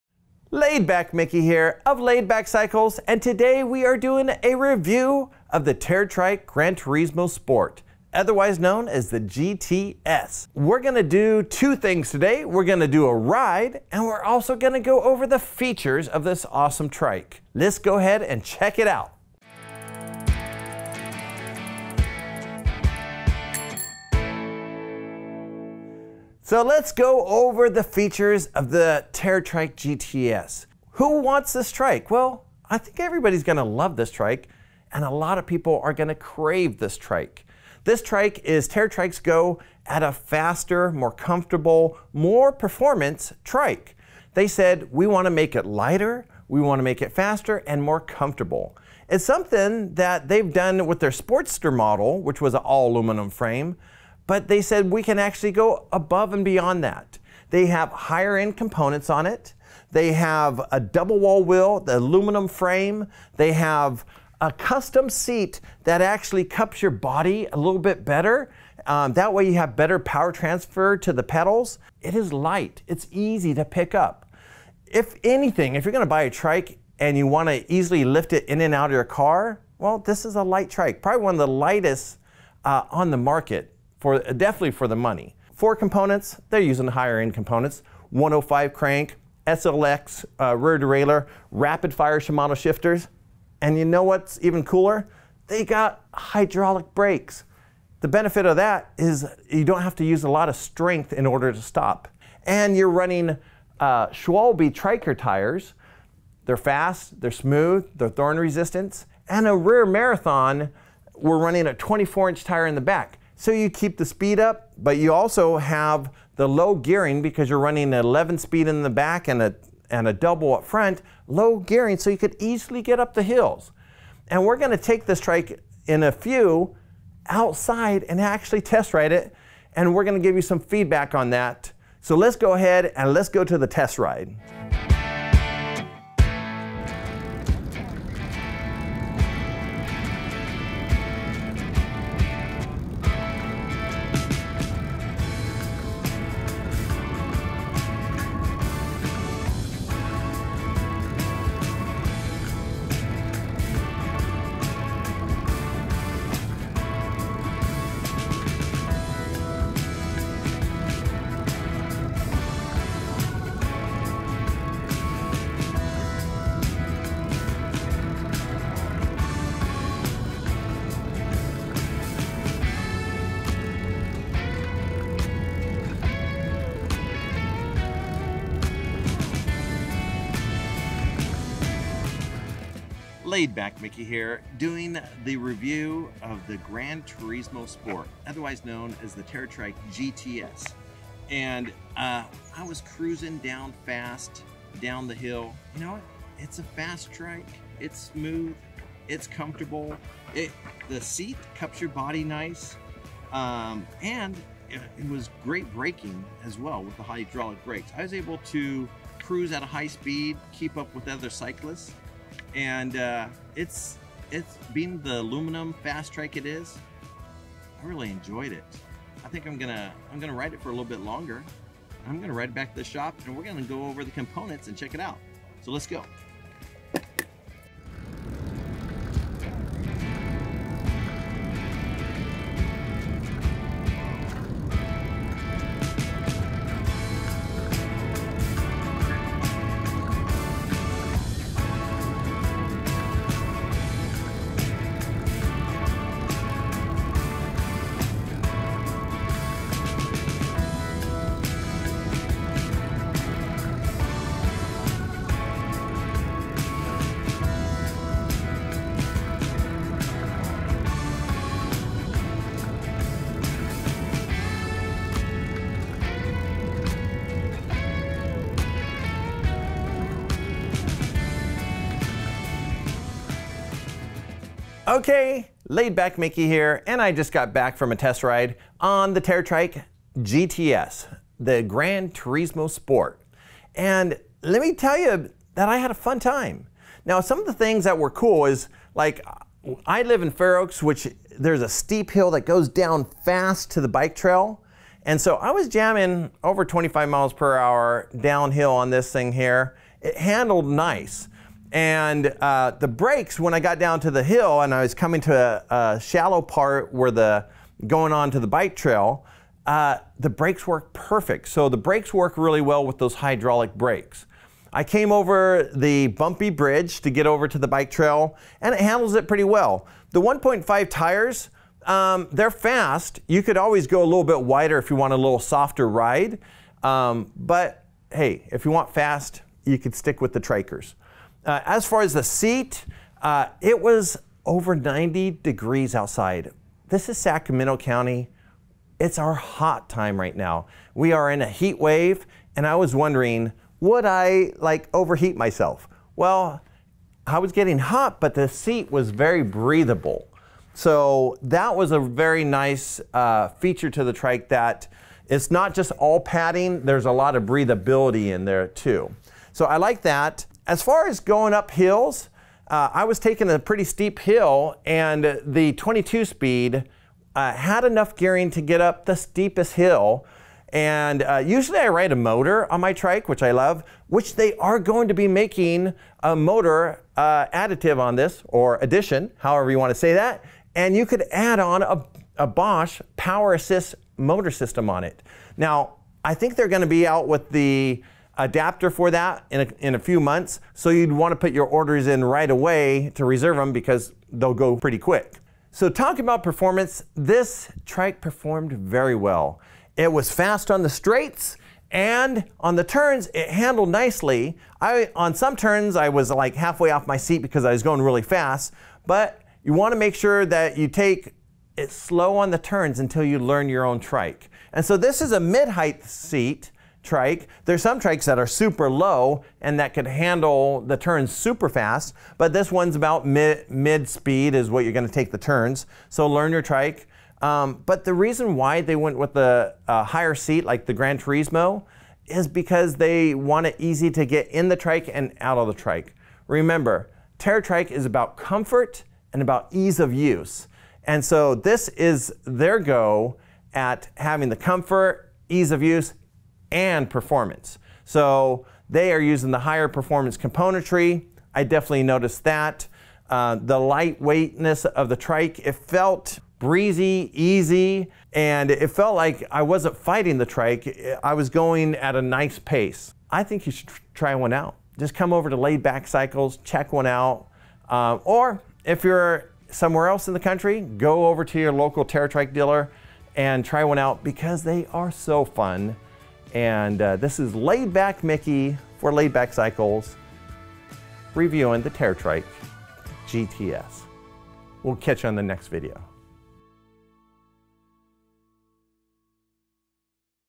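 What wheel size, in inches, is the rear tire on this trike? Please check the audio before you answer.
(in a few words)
24 inch.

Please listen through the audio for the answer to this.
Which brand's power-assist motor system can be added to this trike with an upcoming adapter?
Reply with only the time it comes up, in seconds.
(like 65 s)
382 s.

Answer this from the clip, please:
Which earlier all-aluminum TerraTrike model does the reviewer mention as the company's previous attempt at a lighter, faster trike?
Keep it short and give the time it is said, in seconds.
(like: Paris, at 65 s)
Sportster, at 51 s.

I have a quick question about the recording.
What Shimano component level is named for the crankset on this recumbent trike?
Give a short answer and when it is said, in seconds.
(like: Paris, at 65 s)
105, at 88 s.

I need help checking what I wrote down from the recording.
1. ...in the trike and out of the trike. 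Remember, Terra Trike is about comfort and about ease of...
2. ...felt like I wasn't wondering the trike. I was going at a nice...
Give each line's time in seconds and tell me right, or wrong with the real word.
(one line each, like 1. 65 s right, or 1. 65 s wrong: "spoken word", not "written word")
1. 434 s right
2. 458 s wrong: "fighting", not "wondering".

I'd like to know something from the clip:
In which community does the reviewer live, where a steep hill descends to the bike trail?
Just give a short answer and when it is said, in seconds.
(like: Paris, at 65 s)
Fair Oaks, at 290 s.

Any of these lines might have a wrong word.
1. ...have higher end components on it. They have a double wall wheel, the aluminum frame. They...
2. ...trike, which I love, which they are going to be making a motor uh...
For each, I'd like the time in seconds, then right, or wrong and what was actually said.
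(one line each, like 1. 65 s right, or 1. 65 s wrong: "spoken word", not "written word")
1. 57 s right
2. 372 s right.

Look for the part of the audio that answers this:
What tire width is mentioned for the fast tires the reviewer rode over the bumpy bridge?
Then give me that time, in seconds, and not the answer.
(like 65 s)
320 s.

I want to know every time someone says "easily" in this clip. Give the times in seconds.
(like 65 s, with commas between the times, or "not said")
77 s, 122 s.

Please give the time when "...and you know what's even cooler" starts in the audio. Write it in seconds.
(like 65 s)
93 s.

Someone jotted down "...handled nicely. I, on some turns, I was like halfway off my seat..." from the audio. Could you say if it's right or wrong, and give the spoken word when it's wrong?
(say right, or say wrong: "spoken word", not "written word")
right.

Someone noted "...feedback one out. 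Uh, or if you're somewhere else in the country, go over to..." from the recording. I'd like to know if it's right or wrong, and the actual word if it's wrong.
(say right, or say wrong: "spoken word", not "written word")
wrong: "check", not "feedback".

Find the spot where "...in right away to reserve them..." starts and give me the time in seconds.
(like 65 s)
392 s.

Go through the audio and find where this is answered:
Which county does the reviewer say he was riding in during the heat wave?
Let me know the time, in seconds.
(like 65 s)
337 s.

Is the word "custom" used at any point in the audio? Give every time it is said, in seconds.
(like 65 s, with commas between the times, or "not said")
64 s.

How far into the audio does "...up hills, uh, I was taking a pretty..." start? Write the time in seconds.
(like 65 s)
361 s.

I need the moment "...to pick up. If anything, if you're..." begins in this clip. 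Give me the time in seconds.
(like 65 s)
73 s.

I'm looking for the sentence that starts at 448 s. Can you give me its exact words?
So they are using the higher performance componentry.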